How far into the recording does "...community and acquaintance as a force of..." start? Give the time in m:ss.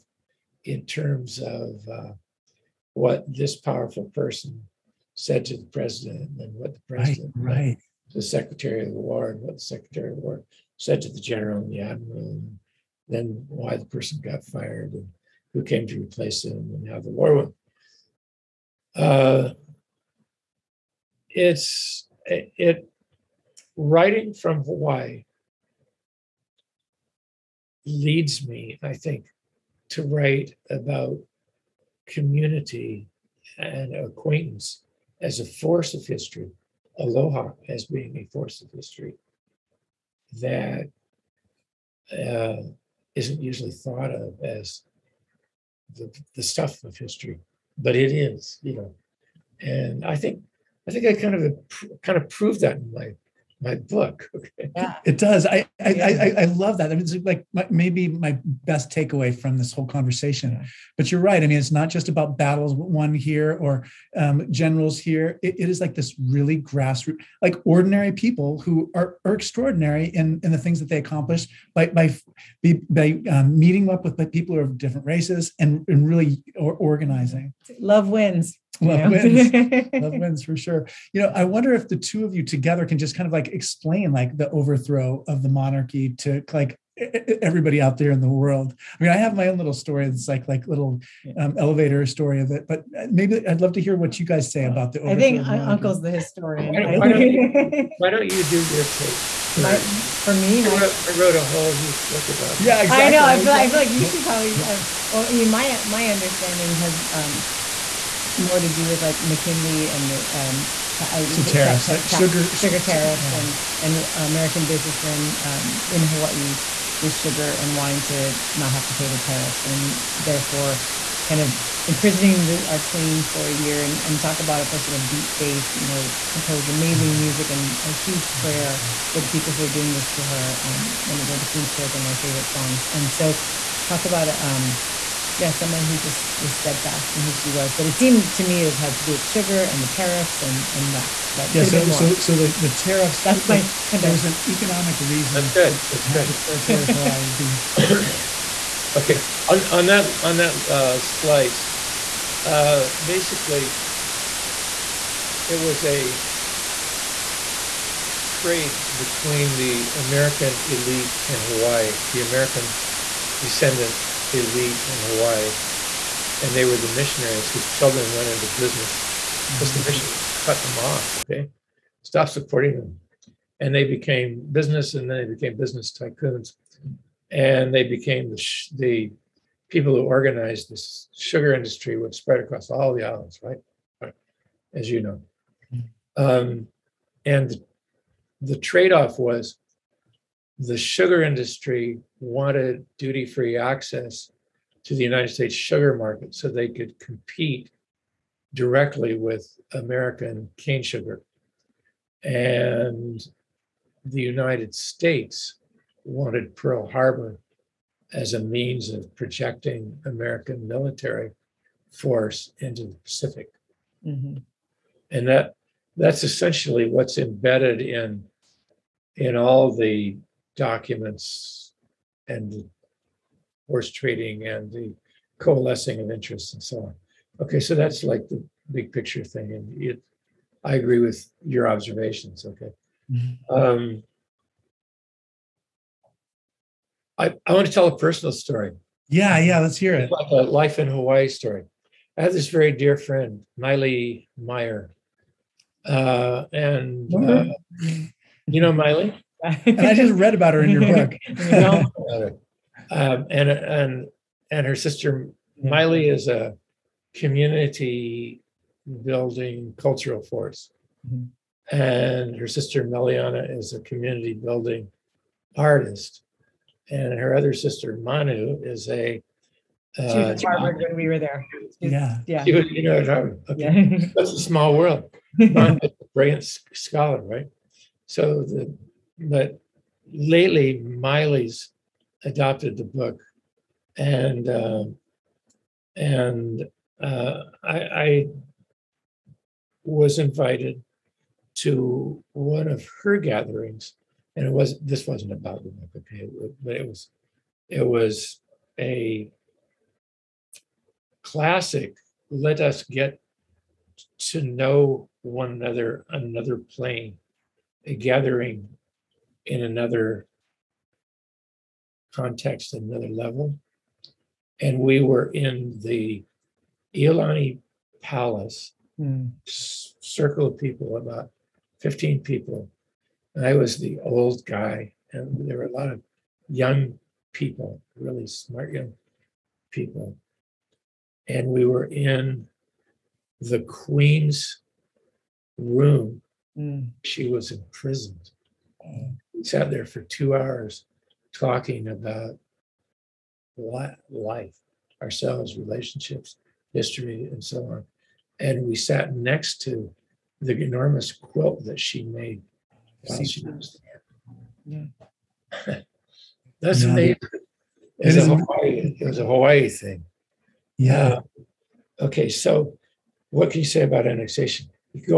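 0:32.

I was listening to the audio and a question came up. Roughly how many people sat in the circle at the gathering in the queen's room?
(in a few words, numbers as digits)
15.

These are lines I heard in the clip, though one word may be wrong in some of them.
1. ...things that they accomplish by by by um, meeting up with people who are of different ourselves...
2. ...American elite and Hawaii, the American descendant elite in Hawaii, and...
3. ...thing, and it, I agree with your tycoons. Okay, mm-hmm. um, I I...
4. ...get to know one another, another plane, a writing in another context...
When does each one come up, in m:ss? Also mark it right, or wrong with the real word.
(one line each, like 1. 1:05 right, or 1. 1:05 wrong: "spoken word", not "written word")
1. 1:10 wrong: "races", not "ourselves"
2. 2:39 right
3. 3:49 wrong: "observations", not "tycoons"
4. 5:02 wrong: "gathering", not "writing".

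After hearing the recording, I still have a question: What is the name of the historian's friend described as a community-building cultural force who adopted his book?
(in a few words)
Miley Meyer.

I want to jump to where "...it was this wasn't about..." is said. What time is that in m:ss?
4:54.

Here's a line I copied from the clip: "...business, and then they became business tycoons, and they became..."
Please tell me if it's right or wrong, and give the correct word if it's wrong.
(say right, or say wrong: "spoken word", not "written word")
right.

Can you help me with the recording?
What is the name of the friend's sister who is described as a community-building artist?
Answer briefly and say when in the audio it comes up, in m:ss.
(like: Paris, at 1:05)
Meleanna, at 4:22.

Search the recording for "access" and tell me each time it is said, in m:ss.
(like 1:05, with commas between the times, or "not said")
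3:13.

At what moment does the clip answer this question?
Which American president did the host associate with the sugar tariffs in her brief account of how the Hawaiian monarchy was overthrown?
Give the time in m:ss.
1:49.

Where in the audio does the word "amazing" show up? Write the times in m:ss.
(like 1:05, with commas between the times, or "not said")
2:06, 5:56.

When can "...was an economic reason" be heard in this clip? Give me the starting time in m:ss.
2:24.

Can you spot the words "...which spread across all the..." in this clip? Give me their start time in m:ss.
3:01.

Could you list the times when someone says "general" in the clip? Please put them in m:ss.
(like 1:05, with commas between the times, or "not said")
0:11, 1:04.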